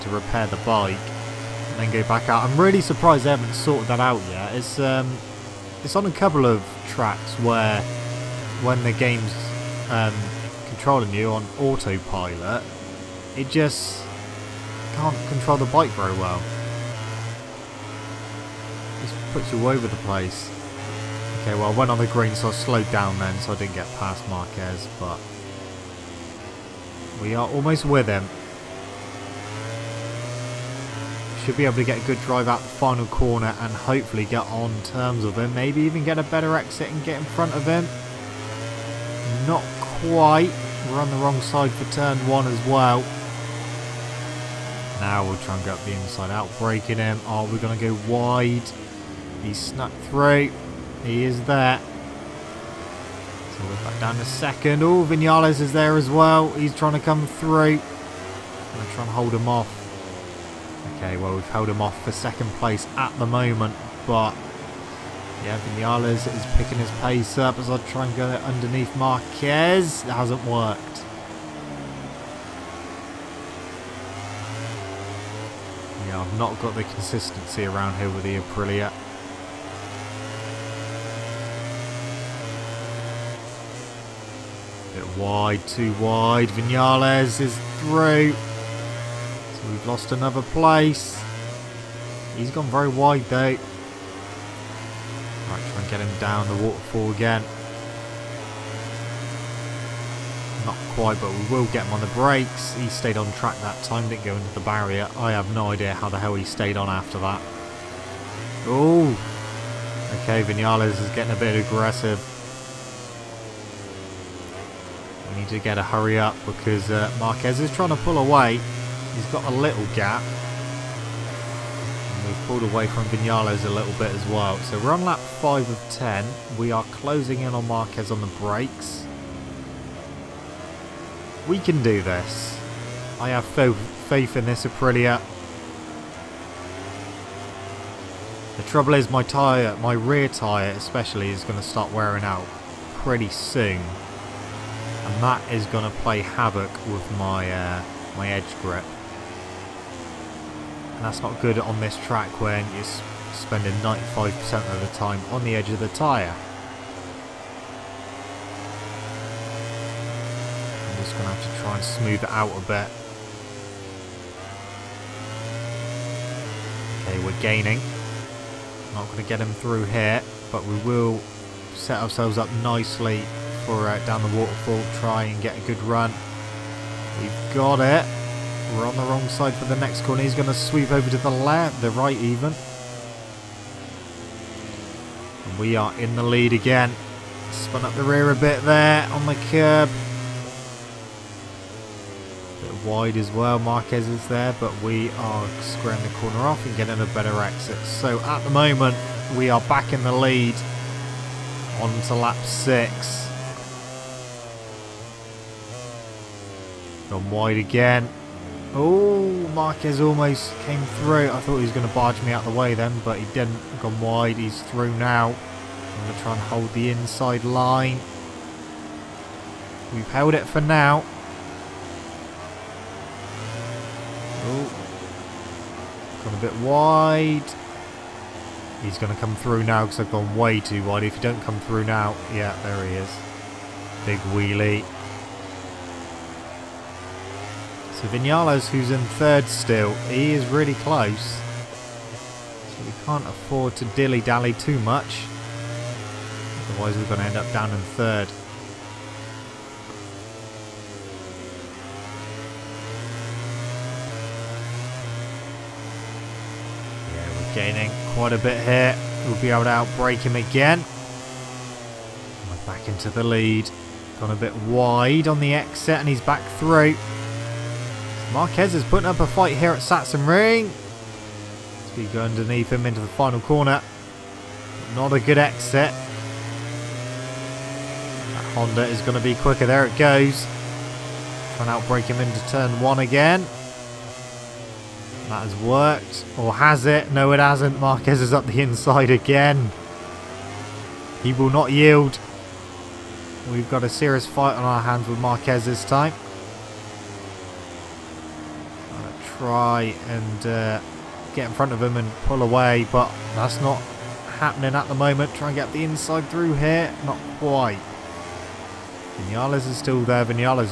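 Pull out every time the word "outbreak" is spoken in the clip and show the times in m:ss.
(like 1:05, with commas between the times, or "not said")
4:19, 4:41.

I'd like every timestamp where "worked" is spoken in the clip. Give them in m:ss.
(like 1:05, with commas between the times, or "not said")
1:10, 4:45.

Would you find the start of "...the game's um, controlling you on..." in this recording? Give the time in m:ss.
0:08.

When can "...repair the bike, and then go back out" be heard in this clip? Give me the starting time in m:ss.
0:00.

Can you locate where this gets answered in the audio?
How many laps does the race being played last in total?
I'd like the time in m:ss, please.
2:05.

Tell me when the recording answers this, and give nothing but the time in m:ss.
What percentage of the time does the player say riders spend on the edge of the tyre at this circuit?
2:33.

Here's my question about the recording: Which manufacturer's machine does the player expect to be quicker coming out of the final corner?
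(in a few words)
Honda.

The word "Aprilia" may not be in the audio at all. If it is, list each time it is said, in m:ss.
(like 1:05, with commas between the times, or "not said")
1:18, 2:14.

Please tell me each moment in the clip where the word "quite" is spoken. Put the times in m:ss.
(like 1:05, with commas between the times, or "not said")
0:39, 1:40, 4:18, 5:07.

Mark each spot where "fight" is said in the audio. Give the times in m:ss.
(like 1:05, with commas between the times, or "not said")
4:29, 4:54.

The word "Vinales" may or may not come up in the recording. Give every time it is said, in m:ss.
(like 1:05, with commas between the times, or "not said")
0:55, 1:05, 1:26, 1:50, 2:03, 3:58, 5:09.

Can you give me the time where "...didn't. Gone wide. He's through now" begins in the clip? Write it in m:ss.
3:33.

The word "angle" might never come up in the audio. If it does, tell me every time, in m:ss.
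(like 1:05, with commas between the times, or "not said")
not said.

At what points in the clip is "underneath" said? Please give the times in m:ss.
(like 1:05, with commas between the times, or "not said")
1:08, 4:32.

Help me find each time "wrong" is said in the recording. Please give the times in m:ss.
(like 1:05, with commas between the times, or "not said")
0:41, 2:59.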